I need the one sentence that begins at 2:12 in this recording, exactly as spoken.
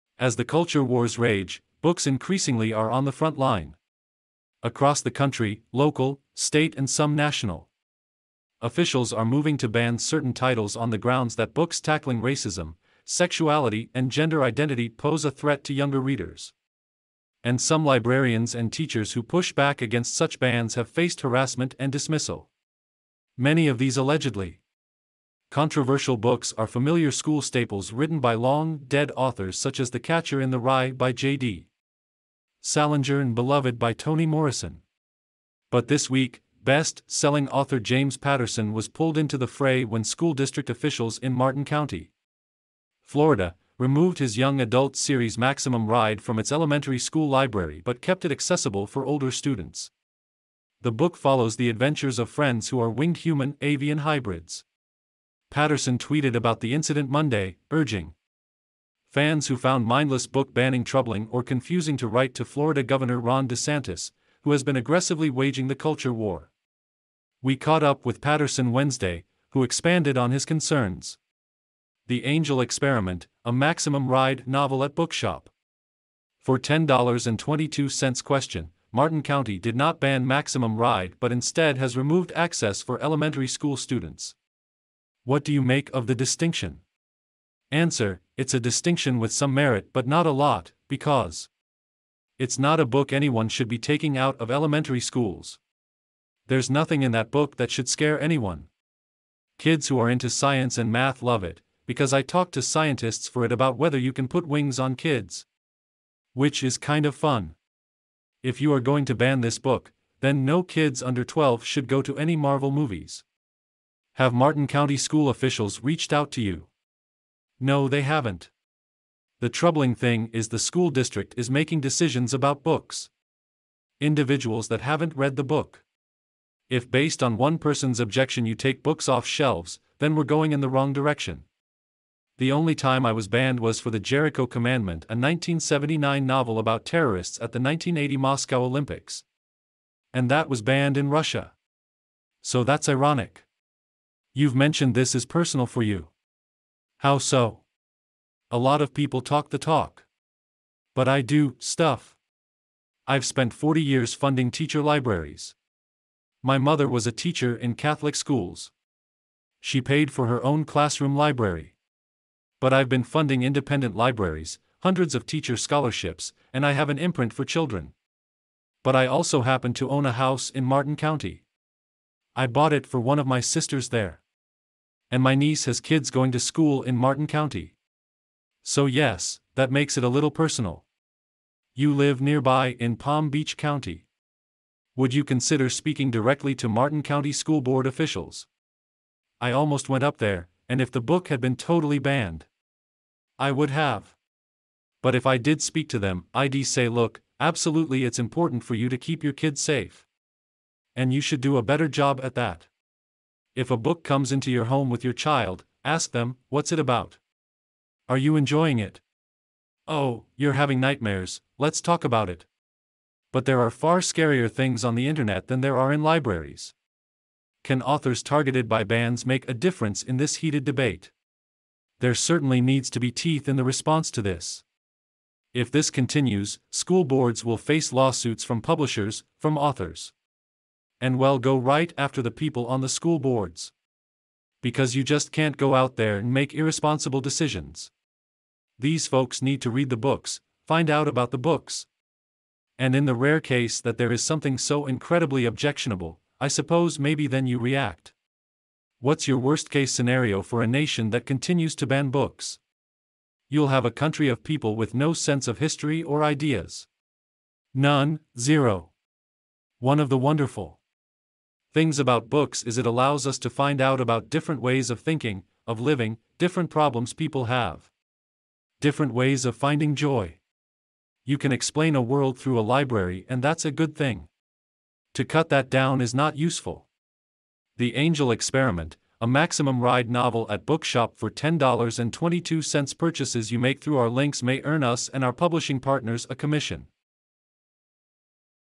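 The only time I was banned was for The Jericho Commandment, a 1979 novel about terrorists at the 1980 Moscow Olympics.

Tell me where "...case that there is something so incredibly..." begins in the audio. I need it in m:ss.
4:03.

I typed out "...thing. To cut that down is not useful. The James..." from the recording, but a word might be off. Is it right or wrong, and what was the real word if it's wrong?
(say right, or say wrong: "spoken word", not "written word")
wrong: "Angel", not "James".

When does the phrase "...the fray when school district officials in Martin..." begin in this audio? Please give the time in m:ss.
0:39.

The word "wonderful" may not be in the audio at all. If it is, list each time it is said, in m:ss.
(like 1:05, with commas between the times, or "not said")
4:20.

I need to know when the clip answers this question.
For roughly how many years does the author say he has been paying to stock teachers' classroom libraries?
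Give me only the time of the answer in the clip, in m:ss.
2:33.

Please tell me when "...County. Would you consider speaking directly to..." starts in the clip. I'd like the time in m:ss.
3:03.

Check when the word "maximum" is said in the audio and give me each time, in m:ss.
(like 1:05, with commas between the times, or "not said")
0:45, 1:13, 1:20, 4:39.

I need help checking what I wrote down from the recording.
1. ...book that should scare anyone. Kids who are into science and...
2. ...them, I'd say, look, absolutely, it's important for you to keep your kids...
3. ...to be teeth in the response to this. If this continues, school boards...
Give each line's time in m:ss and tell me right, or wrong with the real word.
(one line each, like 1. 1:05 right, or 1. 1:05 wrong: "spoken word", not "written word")
1. 1:37 right
2. 3:15 right
3. 3:42 right.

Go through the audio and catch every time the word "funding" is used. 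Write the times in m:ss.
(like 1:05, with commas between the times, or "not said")
2:34, 2:43.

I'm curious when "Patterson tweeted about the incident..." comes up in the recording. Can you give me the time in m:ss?
0:55.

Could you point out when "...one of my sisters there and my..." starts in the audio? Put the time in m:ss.
2:53.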